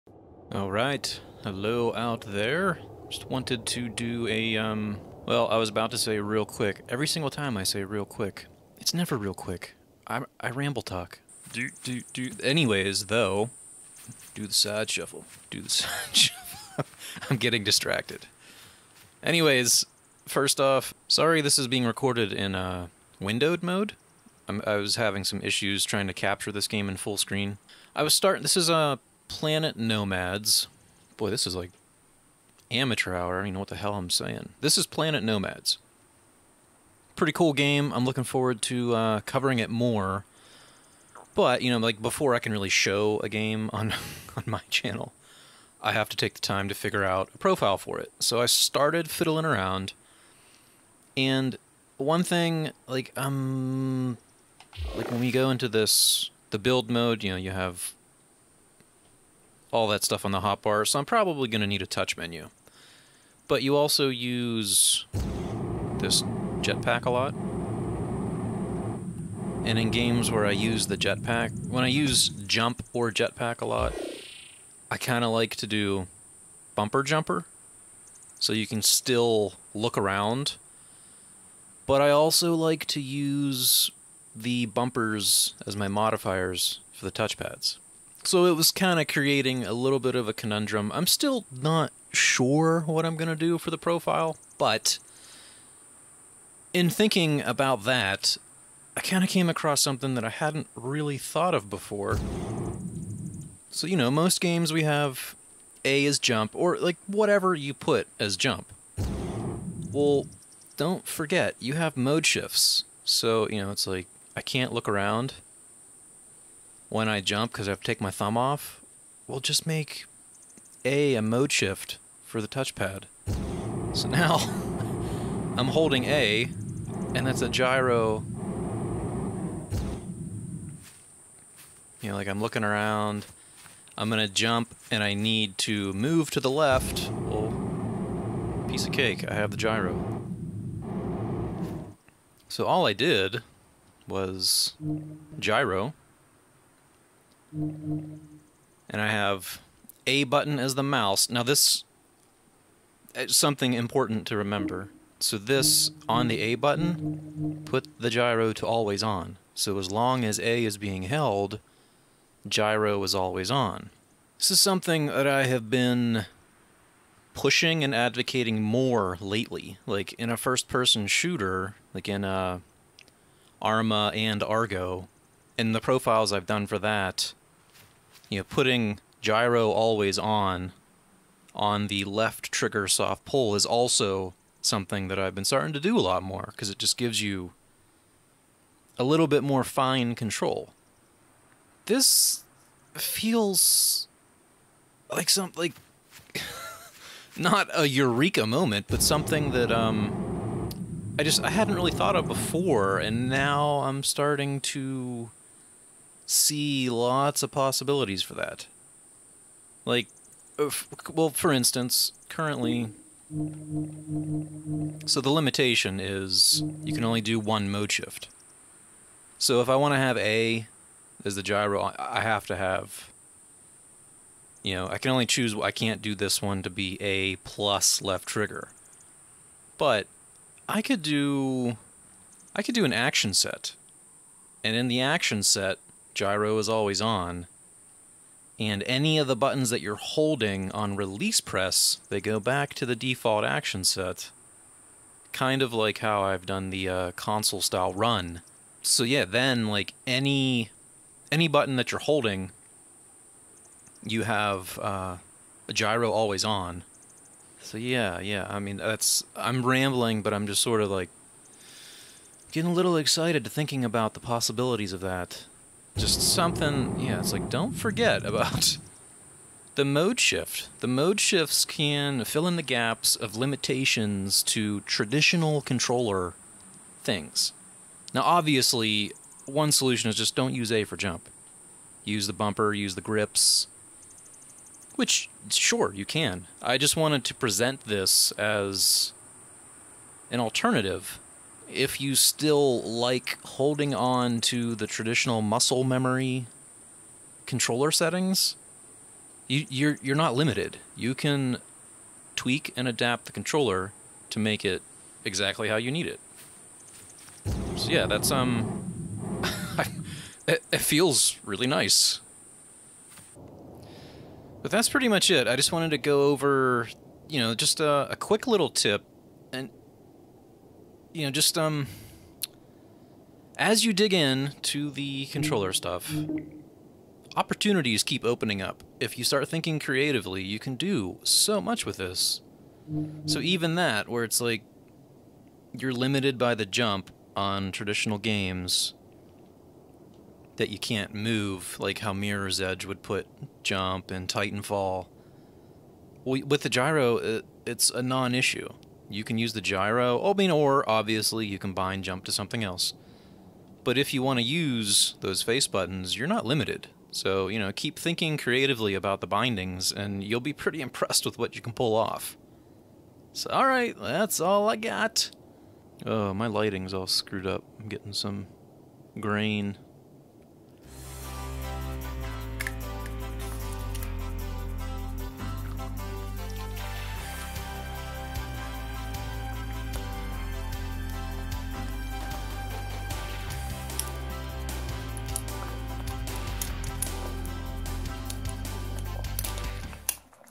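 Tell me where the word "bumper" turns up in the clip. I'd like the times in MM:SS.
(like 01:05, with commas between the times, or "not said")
01:16, 01:24, 04:42.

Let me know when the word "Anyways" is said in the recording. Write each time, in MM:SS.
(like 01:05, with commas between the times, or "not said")
00:12, 00:19.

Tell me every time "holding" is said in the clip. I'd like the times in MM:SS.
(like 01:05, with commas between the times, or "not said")
02:05, 03:59, 04:12, 04:53.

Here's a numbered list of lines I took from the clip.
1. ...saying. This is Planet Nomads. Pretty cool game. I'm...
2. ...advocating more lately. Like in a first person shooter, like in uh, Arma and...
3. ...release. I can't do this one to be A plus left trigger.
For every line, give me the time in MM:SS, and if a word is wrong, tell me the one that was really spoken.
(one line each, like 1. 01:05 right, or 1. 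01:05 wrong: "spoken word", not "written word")
1. 00:34 right
2. 02:47 right
3. 03:45 wrong: "choose", not "release".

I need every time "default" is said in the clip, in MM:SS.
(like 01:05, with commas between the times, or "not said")
04:02.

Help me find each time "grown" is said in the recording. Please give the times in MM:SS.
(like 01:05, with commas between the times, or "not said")
not said.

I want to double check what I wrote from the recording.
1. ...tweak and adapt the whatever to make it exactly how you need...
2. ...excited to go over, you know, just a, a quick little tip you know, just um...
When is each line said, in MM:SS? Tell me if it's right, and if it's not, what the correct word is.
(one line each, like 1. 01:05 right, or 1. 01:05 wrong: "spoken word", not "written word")
1. 05:02 wrong: "controller", not "whatever"
2. 05:15 wrong: "wanted", not "excited".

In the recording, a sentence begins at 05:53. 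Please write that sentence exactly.
But if you want to use those face buttons, you're not limited.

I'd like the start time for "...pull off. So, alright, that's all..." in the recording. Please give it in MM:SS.
06:01.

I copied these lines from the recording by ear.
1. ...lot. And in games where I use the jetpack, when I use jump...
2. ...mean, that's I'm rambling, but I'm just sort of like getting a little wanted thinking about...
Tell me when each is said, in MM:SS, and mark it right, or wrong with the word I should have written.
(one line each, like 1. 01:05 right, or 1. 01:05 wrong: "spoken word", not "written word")
1. 01:07 right
2. 04:18 wrong: "excited", not "wanted".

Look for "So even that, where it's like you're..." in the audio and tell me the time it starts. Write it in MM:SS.
05:33.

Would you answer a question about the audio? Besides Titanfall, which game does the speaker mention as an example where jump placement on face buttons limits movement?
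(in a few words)
Mirror's Edge.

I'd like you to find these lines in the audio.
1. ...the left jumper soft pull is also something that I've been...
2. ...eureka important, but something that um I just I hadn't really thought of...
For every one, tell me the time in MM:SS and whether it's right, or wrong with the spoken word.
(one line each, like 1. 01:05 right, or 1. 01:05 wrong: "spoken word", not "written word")
1. 03:01 wrong: "trigger", not "jumper"
2. 03:17 wrong: "moment", not "important".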